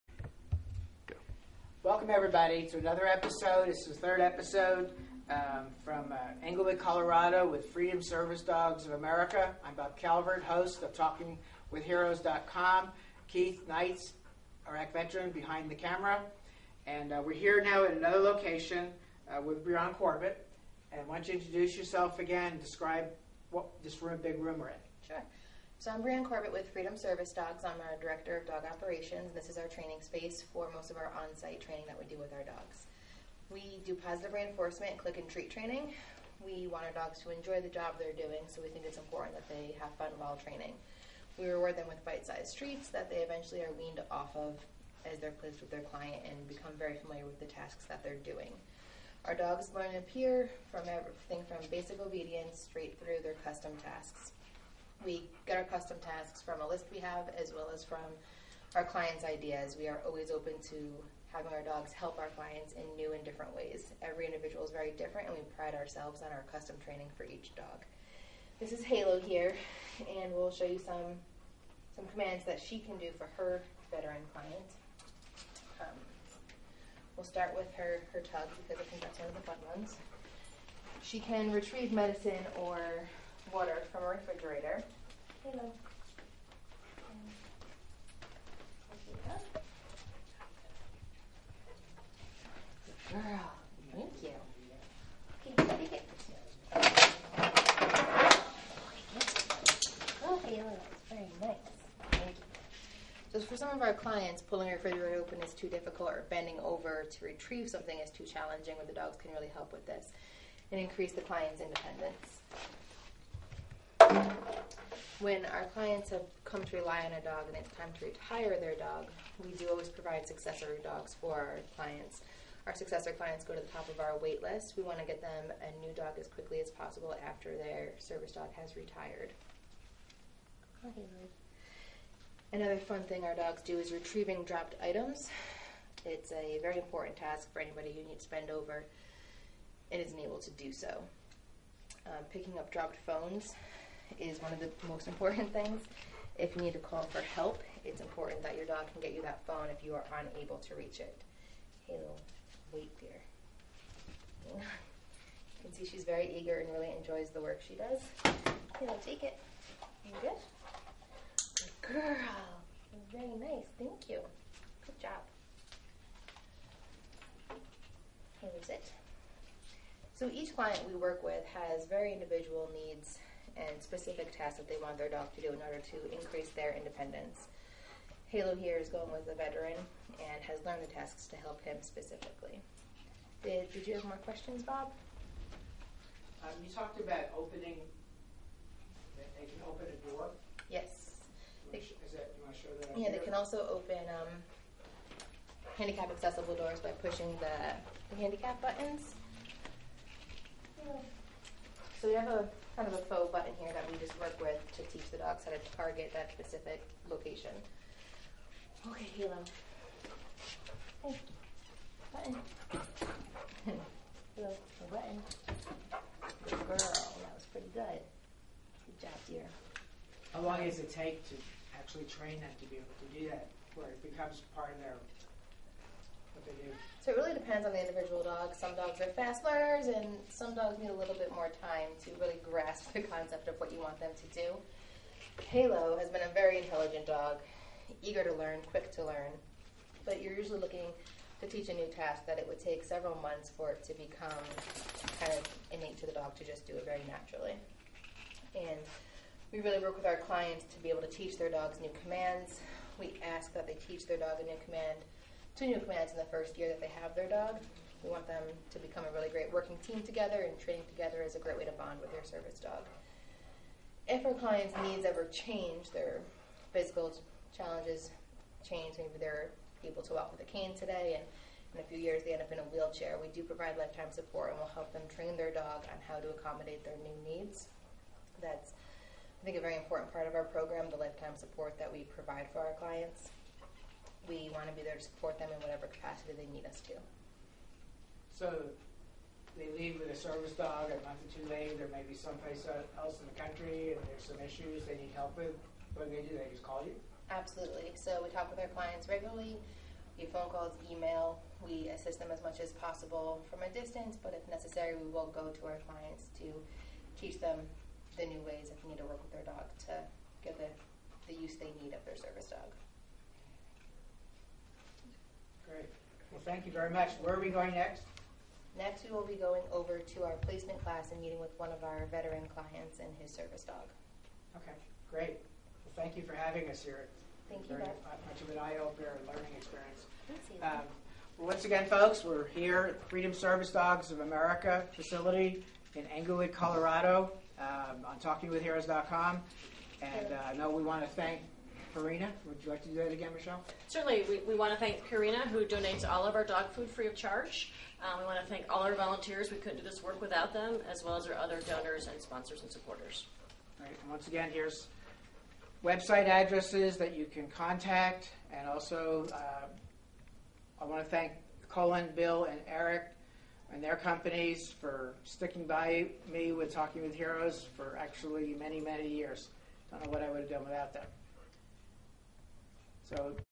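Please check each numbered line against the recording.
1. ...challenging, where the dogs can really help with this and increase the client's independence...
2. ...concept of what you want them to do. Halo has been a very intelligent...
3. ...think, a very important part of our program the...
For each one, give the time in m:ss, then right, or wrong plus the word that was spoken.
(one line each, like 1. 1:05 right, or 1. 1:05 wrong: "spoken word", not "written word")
1. 1:48 right
2. 3:53 right
3. 4:39 right.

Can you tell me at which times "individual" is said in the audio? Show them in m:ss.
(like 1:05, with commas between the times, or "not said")
1:04, 2:52, 3:47.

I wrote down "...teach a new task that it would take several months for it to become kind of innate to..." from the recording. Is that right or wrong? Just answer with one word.
right.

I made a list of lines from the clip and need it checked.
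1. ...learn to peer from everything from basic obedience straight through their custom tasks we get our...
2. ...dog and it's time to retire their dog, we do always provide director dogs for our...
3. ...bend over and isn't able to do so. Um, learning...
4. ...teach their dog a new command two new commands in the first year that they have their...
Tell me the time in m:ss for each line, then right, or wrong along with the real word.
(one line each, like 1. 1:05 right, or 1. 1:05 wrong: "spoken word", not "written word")
1. 0:49 right
2. 1:57 wrong: "successor", not "director"
3. 2:18 wrong: "picking", not "learning"
4. 4:13 right.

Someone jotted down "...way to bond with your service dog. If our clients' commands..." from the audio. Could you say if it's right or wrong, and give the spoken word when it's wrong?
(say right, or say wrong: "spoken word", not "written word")
wrong: "needs", not "commands".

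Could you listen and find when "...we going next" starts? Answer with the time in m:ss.
5:17.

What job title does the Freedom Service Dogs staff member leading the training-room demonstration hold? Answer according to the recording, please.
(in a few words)
Director of dog operations.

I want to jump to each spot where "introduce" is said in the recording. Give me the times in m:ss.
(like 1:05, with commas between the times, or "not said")
0:21.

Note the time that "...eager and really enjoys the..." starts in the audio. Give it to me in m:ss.
2:36.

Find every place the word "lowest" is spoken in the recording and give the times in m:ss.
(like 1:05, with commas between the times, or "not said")
not said.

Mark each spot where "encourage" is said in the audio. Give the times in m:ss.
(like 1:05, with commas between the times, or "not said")
not said.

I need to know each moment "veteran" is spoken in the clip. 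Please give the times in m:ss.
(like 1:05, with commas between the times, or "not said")
0:14, 1:13, 2:59, 5:22.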